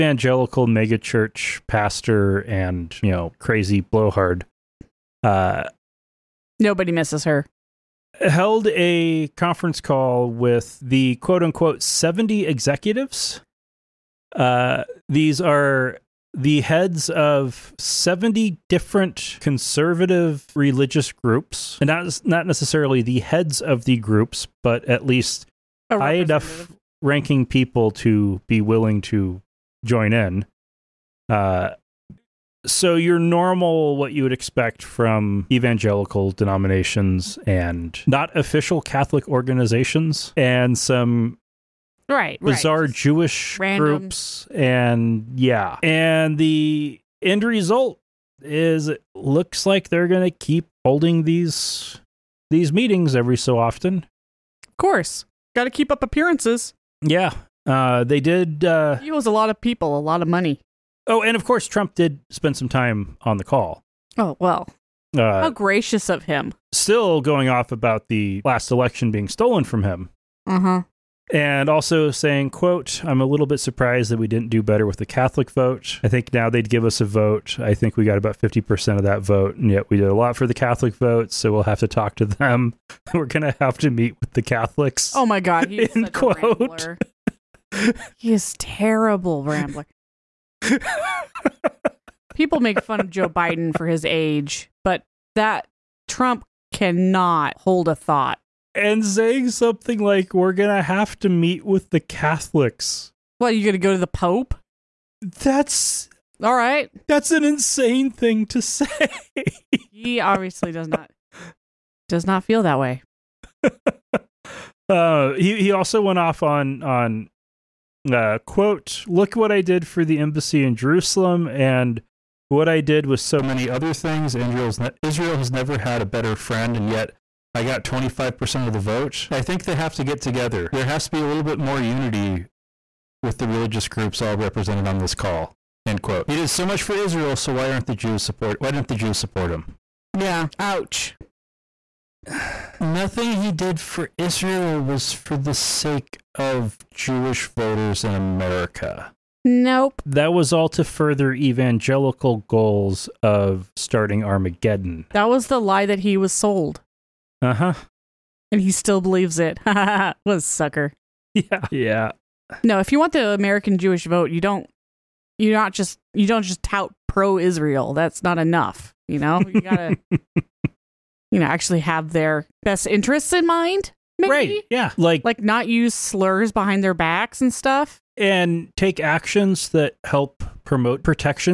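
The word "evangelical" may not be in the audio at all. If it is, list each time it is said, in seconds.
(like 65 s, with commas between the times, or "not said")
35 s, 151 s.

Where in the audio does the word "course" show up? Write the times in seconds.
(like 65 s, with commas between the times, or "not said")
54 s, 61 s.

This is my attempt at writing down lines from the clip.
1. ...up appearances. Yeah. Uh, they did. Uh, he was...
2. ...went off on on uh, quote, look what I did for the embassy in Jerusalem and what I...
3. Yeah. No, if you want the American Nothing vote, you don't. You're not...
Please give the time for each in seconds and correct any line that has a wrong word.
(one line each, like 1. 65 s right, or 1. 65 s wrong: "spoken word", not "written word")
1. 55 s right
2. 116 s right
3. 161 s wrong: "Jewish", not "Nothing".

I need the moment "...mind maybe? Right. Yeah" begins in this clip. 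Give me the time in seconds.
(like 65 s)
173 s.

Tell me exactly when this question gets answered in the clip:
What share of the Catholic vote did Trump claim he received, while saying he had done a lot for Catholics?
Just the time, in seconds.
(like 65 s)
78 s.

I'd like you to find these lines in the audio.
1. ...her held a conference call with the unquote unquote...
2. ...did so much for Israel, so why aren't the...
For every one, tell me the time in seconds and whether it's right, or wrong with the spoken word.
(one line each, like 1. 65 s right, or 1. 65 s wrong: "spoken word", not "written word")
1. 7 s wrong: "quote", not "unquote"
2. 136 s right.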